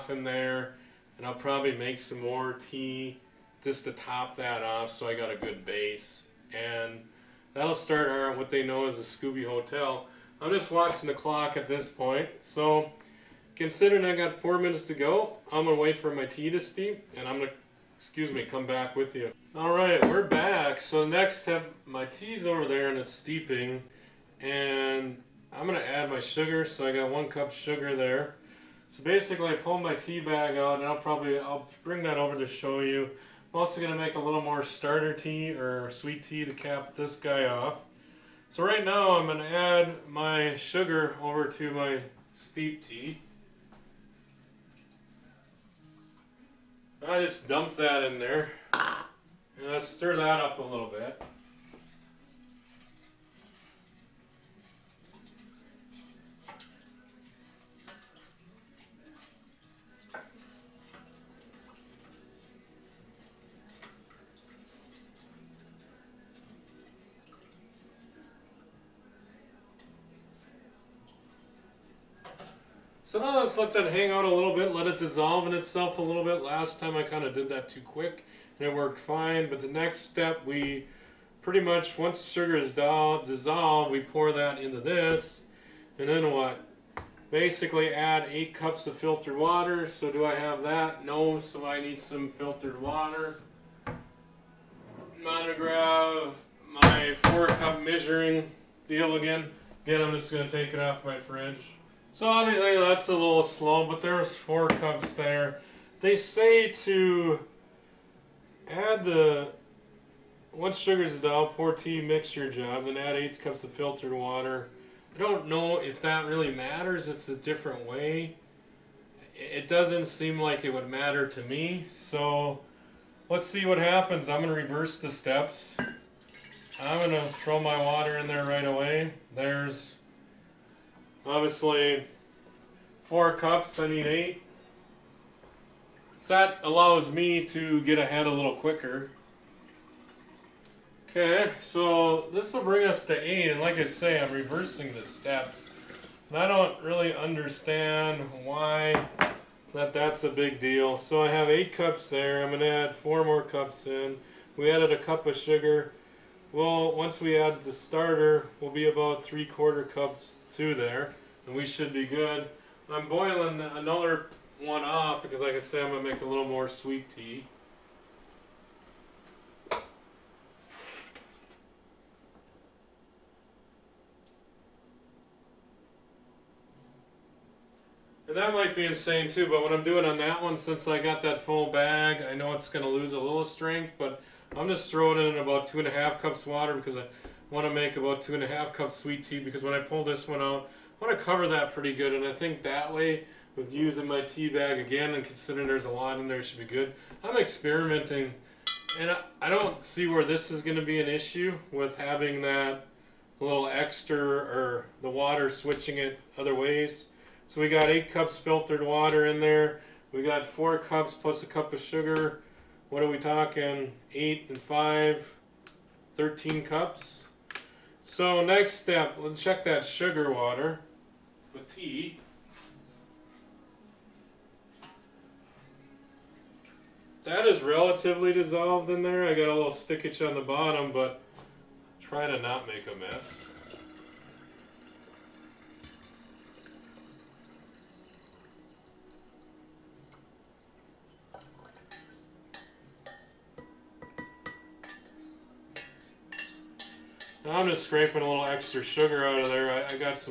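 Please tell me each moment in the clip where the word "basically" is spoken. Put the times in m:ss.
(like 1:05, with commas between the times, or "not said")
0:29, 1:27.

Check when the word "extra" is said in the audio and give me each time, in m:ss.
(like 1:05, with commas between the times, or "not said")
3:23, 4:08.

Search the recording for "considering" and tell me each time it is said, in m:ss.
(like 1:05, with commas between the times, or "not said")
0:13, 3:15.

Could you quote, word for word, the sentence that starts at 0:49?
let's stir that up a little bit.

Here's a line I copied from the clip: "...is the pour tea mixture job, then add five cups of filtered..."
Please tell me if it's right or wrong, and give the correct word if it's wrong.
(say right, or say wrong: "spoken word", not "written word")
wrong: "eight", not "five".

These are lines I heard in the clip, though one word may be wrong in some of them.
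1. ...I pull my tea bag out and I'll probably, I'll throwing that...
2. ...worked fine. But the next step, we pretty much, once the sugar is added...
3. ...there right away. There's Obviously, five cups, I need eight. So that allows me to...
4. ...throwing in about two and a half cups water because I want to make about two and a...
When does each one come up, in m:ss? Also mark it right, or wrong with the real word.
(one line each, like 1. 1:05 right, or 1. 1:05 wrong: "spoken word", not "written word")
1. 0:29 wrong: "bring", not "throwing"
2. 1:18 wrong: "dissolved", not "added"
3. 2:08 wrong: "four", not "five"
4. 3:04 right.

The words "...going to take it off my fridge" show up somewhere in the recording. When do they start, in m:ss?
1:40.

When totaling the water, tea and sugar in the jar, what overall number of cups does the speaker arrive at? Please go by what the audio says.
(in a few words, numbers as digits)
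13 cups.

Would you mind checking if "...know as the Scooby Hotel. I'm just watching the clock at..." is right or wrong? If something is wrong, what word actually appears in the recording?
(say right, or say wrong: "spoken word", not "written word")
right.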